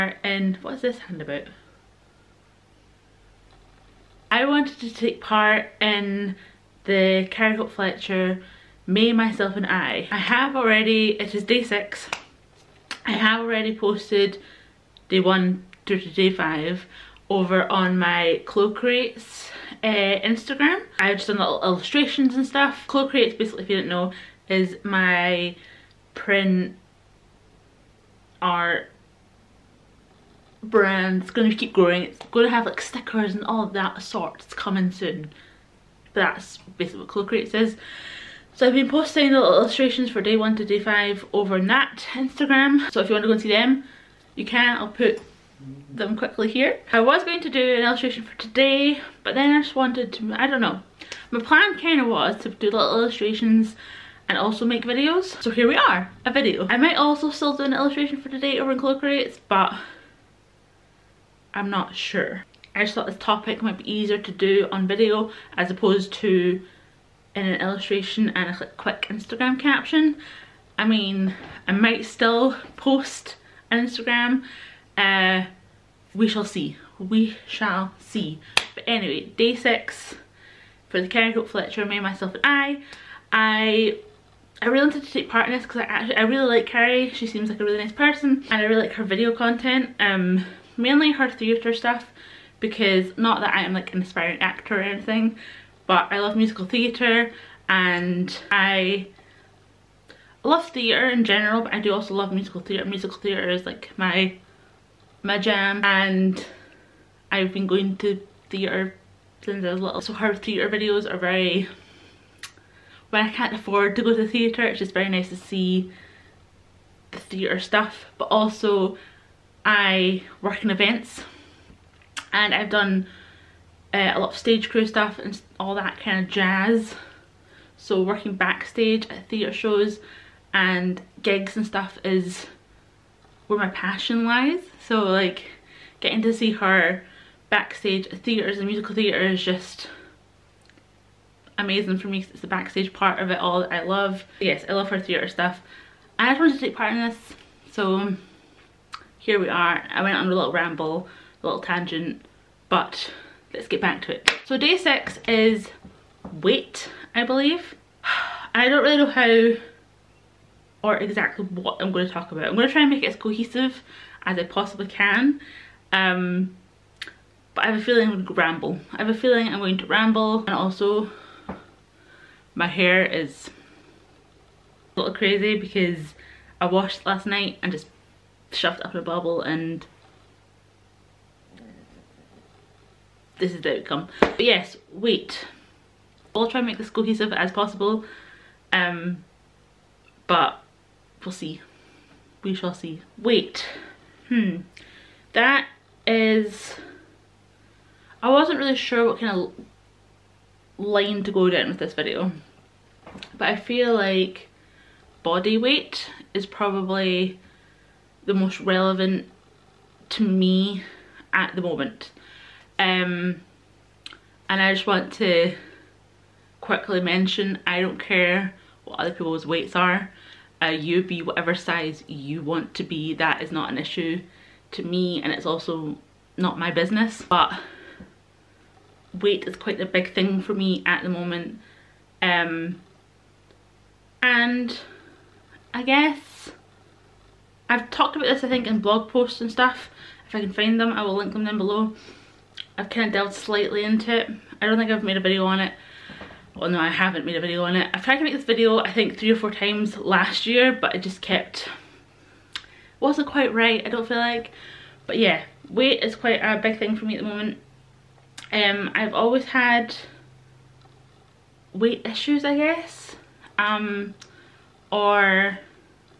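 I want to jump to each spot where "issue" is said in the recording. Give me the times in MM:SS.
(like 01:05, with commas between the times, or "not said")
03:43, 04:22.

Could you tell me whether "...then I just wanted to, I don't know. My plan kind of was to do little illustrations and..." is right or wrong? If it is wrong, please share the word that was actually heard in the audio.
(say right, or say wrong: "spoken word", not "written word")
right.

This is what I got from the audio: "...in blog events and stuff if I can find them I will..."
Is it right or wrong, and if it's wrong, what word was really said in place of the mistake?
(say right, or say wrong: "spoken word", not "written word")
wrong: "posts", not "events".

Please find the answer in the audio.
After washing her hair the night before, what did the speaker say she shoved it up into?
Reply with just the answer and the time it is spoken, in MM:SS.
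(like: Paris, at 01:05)
a bubble, at 02:59.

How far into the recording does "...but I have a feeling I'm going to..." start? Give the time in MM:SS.
02:47.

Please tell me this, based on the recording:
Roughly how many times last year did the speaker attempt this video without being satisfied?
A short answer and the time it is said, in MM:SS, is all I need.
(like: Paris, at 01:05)
3 or 4, at 04:09.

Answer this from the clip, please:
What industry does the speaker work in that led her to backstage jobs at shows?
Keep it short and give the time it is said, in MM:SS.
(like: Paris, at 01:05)
events, at 02:00.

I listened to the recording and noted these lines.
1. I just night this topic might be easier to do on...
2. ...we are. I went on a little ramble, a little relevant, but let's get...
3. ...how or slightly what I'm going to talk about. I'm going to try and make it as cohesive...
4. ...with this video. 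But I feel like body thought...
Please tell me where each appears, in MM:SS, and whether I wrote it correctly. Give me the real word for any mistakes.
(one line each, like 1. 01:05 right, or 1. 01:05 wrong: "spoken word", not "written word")
1. 01:02 wrong: "thought", not "night"
2. 02:29 wrong: "tangent", not "relevant"
3. 02:39 wrong: "exactly", not "slightly"
4. 03:21 wrong: "weight", not "thought".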